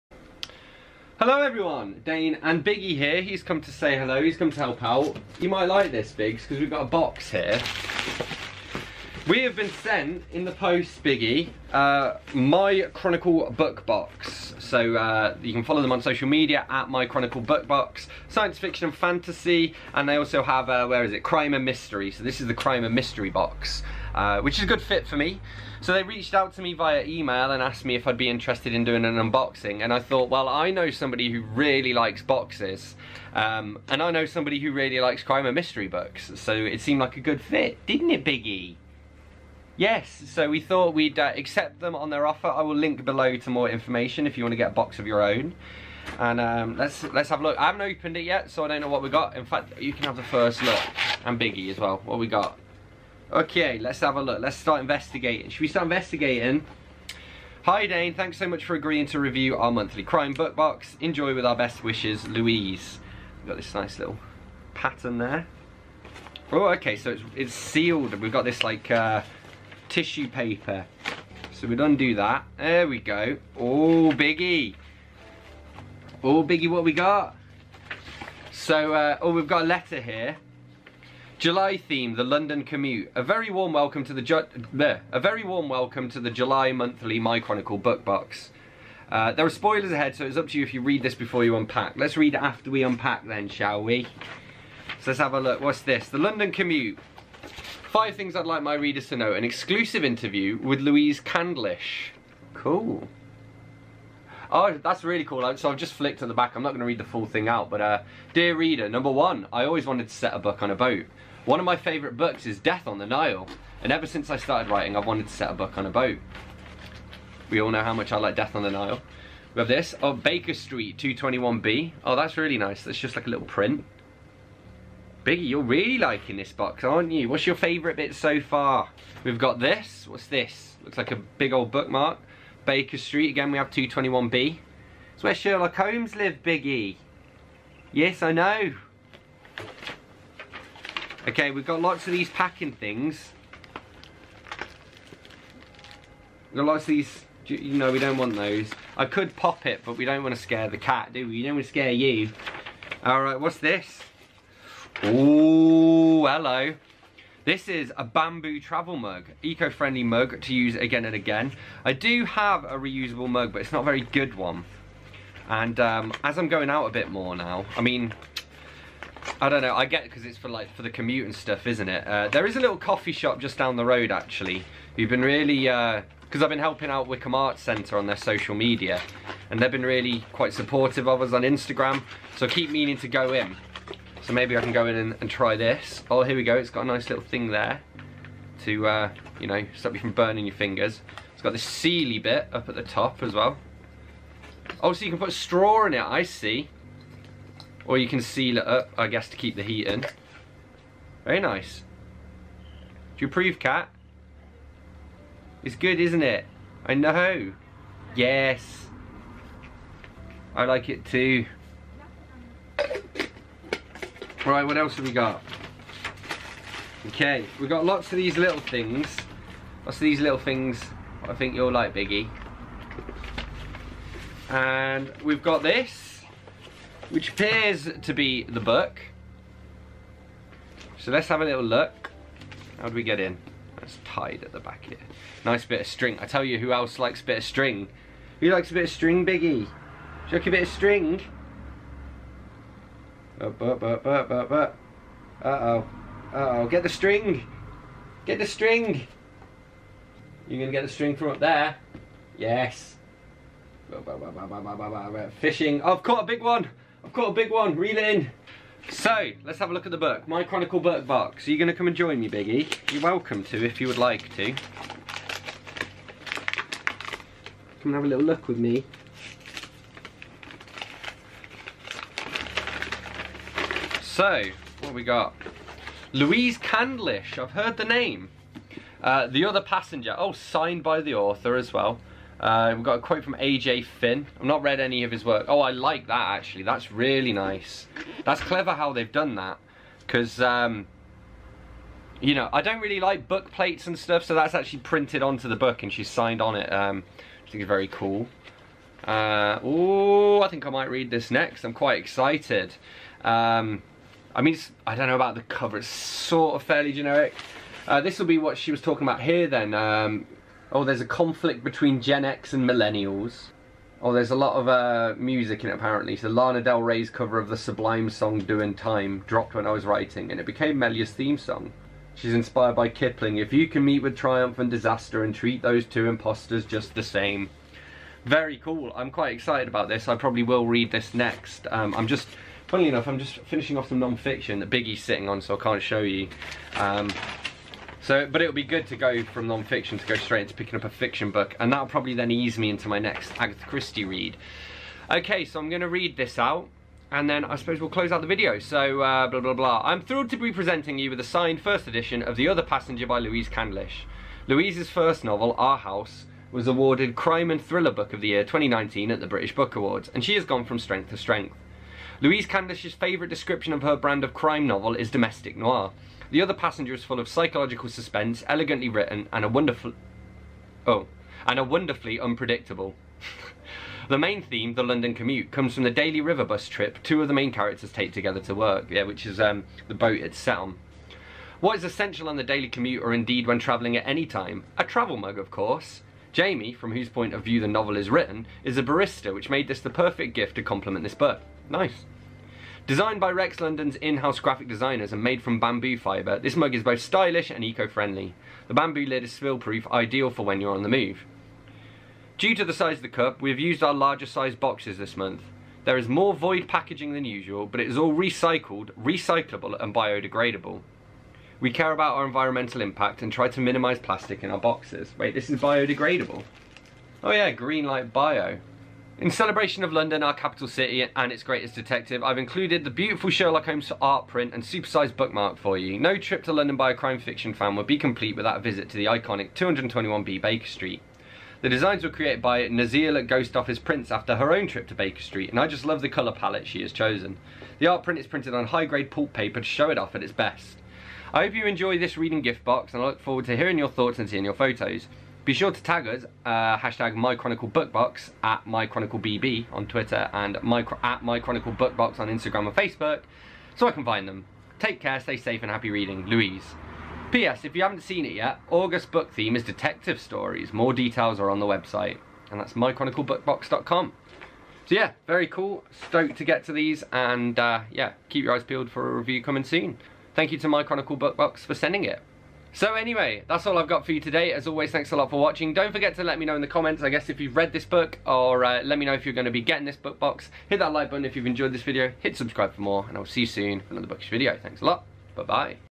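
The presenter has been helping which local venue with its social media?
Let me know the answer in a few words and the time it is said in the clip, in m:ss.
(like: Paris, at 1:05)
Wycombe Arts Centre, at 2:57.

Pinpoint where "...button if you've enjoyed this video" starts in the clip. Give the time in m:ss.
8:01.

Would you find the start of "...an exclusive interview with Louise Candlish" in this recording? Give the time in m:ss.
1:39.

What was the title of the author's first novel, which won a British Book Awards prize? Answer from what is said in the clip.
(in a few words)
Our House.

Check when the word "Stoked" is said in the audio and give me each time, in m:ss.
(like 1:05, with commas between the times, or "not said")
7:46.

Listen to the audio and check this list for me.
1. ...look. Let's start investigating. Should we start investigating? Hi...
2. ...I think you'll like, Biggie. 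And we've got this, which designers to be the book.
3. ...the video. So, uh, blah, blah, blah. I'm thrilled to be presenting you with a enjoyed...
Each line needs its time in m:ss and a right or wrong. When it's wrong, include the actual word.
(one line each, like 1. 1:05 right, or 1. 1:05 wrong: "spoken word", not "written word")
1. 0:54 right
2. 3:41 wrong: "appears", not "designers"
3. 5:48 wrong: "signed", not "enjoyed".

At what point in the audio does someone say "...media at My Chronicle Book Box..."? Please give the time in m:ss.
0:16.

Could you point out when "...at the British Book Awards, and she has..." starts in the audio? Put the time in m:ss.
5:59.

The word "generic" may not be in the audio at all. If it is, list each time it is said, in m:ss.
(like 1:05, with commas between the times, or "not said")
5:06.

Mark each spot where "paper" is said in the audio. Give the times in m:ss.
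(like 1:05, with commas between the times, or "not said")
1:10, 7:19.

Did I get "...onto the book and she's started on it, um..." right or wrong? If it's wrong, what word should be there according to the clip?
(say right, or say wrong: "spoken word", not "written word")
wrong: "signed", not "started".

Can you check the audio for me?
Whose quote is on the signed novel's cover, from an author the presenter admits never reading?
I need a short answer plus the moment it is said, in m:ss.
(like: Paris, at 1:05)
AJ Finn, at 4:43.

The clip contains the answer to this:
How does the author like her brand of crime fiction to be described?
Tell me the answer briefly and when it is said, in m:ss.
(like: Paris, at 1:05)
Domestic noir, at 6:05.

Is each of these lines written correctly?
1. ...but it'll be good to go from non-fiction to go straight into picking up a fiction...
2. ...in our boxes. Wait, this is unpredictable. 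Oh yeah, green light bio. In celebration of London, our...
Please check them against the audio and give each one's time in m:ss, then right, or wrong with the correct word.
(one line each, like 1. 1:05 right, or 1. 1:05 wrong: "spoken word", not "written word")
1. 5:38 right
2. 6:54 wrong: "biodegradable", not "unpredictable".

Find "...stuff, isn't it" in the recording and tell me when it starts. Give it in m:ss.
2:51.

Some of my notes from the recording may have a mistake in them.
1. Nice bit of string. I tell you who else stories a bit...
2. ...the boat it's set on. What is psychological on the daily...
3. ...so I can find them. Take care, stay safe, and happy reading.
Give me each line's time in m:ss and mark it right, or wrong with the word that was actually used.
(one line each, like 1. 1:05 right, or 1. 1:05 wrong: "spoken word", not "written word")
1. 3:55 wrong: "likes", not "stories"
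2. 6:19 wrong: "essential", not "psychological"
3. 7:33 right.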